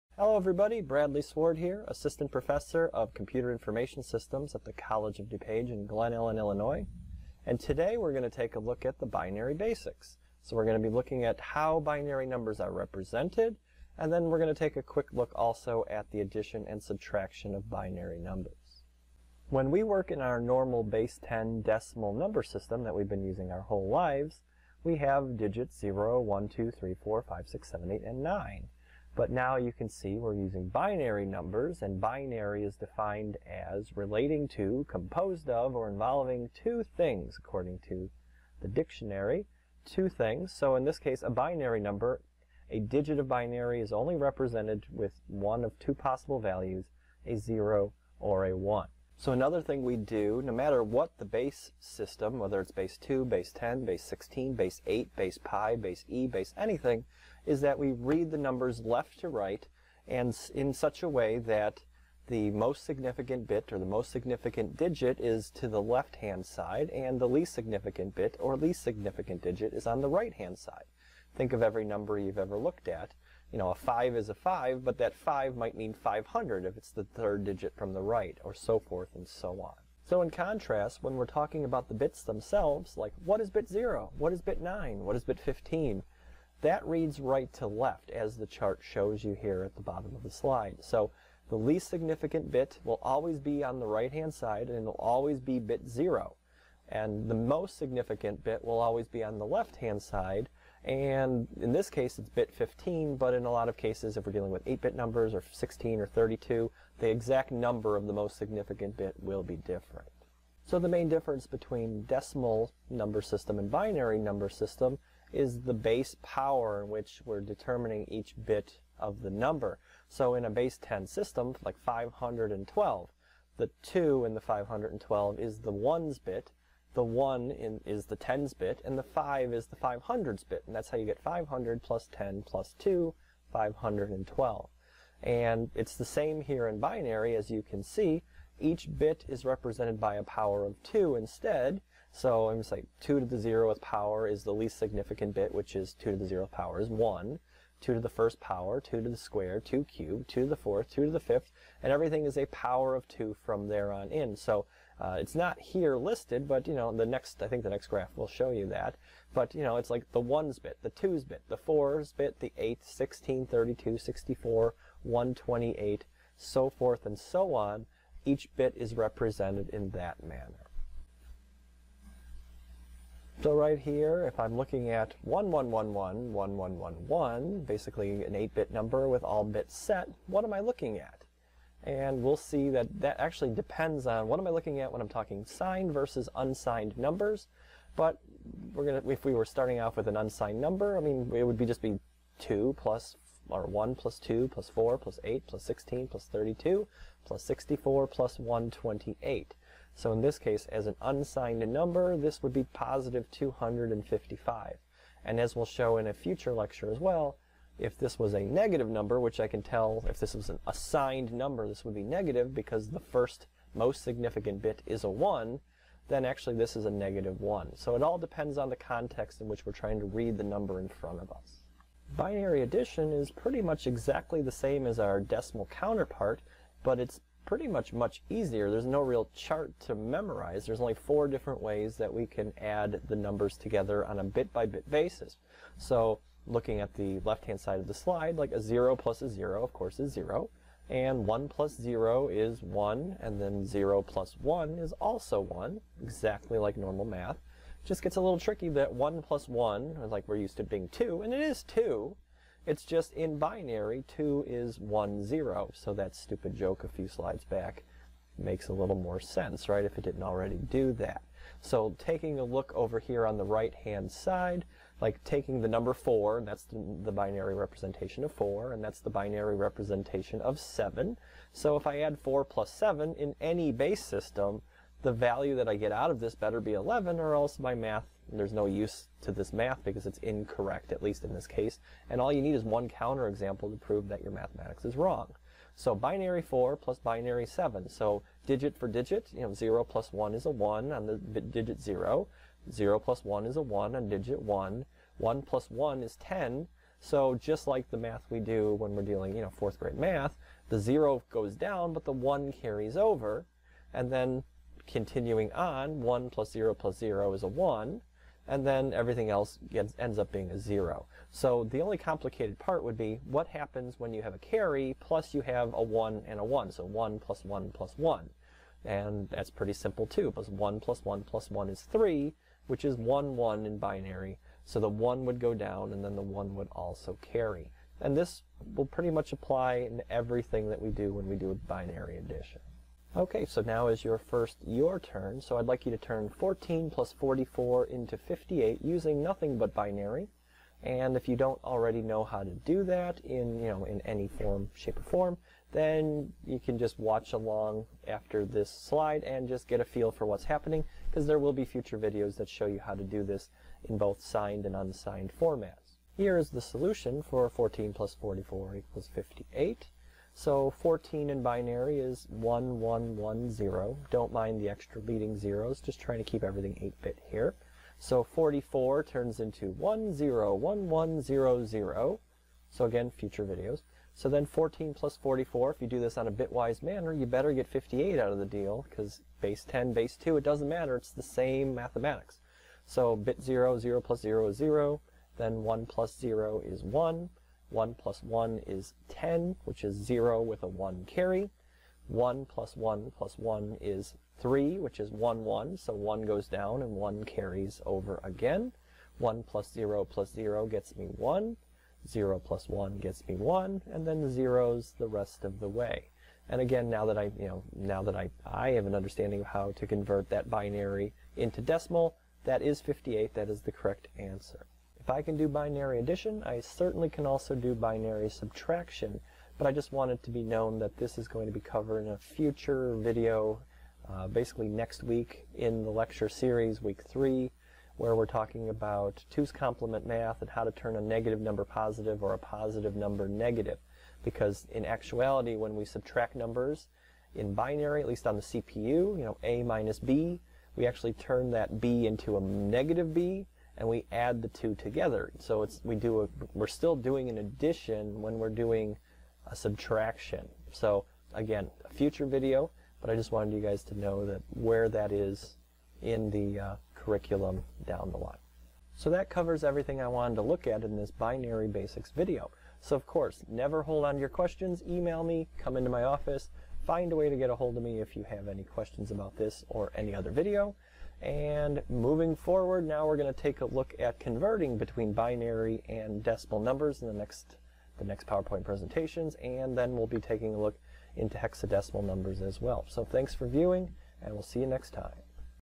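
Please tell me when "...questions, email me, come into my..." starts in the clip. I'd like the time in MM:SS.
07:44.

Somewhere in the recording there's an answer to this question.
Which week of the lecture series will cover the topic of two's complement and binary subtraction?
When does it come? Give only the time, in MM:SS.
07:06.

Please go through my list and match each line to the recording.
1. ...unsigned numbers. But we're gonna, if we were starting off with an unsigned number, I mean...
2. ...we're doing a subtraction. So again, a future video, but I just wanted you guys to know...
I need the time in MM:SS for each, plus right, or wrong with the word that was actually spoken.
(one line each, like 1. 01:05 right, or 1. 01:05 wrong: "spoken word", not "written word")
1. 03:06 right
2. 07:28 right.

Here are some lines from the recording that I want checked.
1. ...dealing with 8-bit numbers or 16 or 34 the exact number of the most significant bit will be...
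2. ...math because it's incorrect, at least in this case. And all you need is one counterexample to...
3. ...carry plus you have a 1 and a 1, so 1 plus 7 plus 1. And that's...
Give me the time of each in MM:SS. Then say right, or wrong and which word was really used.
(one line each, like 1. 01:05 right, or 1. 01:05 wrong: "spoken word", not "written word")
1. 01:44 wrong: "32", not "34"
2. 04:39 right
3. 05:14 wrong: "1", not "7".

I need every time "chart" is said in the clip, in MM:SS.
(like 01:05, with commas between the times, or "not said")
01:28, 03:49.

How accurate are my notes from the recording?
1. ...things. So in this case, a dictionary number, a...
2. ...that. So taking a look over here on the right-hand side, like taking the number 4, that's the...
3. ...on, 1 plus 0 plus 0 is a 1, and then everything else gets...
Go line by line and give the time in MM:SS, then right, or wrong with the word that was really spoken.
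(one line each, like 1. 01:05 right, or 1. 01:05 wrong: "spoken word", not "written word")
1. 00:40 wrong: "binary", not "dictionary"
2. 04:20 right
3. 05:05 right.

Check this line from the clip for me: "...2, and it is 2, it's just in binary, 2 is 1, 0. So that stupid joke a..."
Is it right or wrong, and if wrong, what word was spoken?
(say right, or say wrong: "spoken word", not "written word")
right.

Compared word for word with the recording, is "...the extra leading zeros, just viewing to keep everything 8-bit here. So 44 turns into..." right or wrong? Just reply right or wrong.
wrong.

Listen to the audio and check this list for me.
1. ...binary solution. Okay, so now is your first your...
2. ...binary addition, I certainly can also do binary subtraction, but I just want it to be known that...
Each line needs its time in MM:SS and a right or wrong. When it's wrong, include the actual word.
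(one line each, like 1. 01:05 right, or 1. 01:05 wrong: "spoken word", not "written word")
1. 05:31 wrong: "addition", not "solution"
2. 06:55 right.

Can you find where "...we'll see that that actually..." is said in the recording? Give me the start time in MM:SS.
03:02.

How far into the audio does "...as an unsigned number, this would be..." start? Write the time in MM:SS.
03:20.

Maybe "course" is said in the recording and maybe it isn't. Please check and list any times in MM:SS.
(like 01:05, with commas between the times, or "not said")
03:59, 07:43.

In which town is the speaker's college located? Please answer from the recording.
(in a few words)
Glen Ellyn, Illinois.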